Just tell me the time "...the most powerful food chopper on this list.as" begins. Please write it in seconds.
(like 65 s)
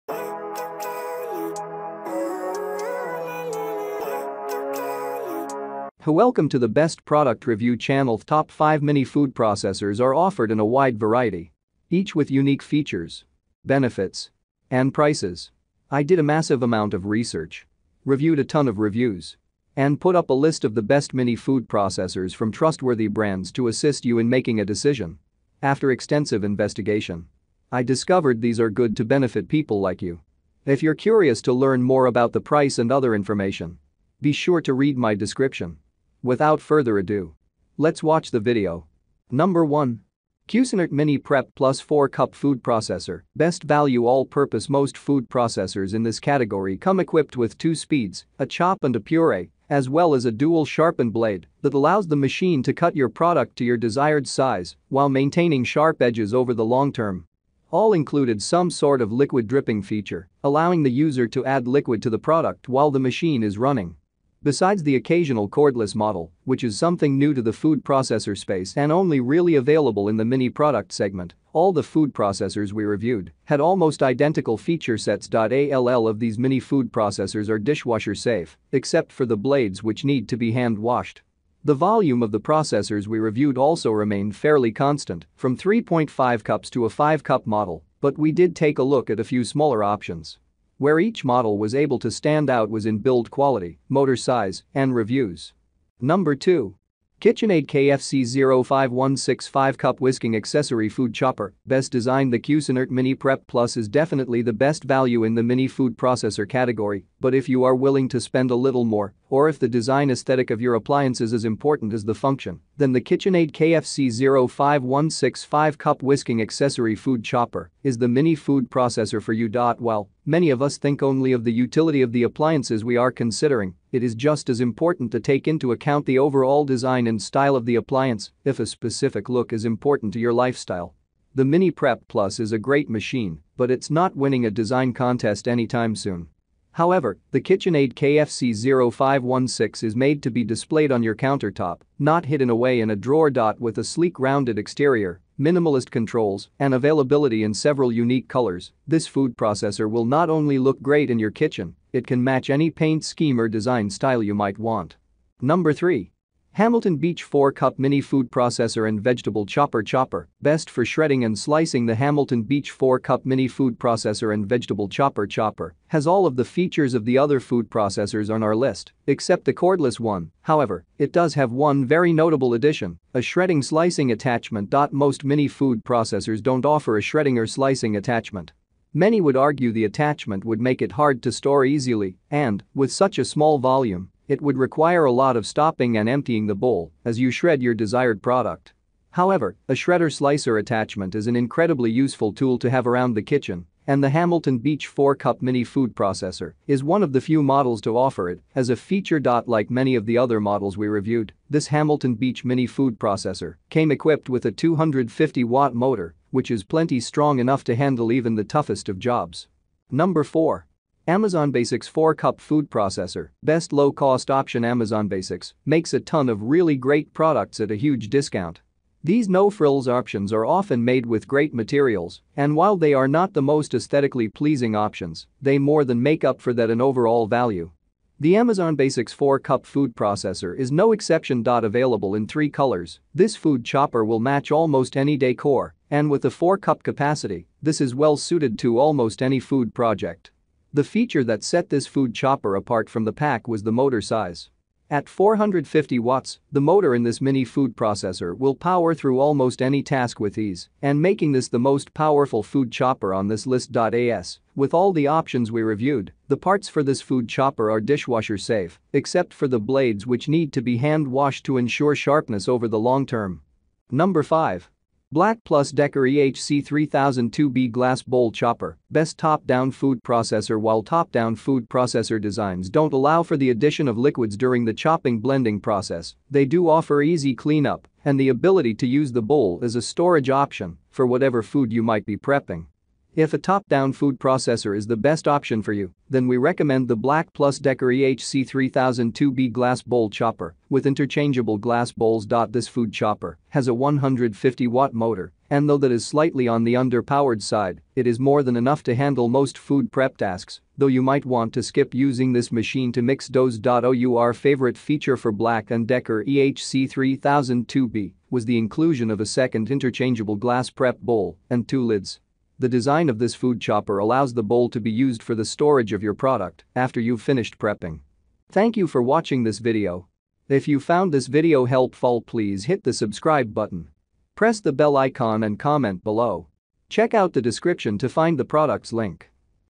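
251 s.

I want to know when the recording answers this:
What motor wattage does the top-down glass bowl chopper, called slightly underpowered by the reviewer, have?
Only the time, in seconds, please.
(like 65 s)
293 s.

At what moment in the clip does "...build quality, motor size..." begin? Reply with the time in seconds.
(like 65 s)
92 s.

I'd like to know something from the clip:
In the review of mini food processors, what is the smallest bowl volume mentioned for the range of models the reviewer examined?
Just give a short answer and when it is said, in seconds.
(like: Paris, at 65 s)
3.5 cups, at 85 s.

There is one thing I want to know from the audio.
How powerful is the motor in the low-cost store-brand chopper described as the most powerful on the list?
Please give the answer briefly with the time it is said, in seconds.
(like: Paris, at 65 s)
450 watts, at 245 s.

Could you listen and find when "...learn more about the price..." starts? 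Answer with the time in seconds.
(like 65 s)
31 s.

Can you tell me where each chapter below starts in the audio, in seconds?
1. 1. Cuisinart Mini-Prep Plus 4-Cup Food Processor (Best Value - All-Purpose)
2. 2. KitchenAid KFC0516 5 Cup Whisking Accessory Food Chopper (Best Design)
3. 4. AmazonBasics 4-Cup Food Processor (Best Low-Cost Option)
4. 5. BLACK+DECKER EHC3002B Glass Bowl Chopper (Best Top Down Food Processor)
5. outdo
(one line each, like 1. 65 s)
1. 38 s
2. 95 s
3. 210 s
4. 264 s
5. 318 s.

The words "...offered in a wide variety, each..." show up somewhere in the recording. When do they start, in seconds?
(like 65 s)
10 s.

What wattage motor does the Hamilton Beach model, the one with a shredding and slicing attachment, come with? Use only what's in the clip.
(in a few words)
250 watts.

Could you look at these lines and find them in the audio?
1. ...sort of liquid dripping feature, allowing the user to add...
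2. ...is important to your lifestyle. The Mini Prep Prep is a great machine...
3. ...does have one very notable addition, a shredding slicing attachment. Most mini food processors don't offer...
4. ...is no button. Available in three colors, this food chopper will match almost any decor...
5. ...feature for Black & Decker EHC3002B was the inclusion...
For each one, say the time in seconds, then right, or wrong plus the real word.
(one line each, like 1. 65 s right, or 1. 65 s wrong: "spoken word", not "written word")
1. 58 s right
2. 129 s wrong: "Plus", not "Prep"
3. 171 s right
4. 230 s wrong: "exception", not "button"
5. 304 s right.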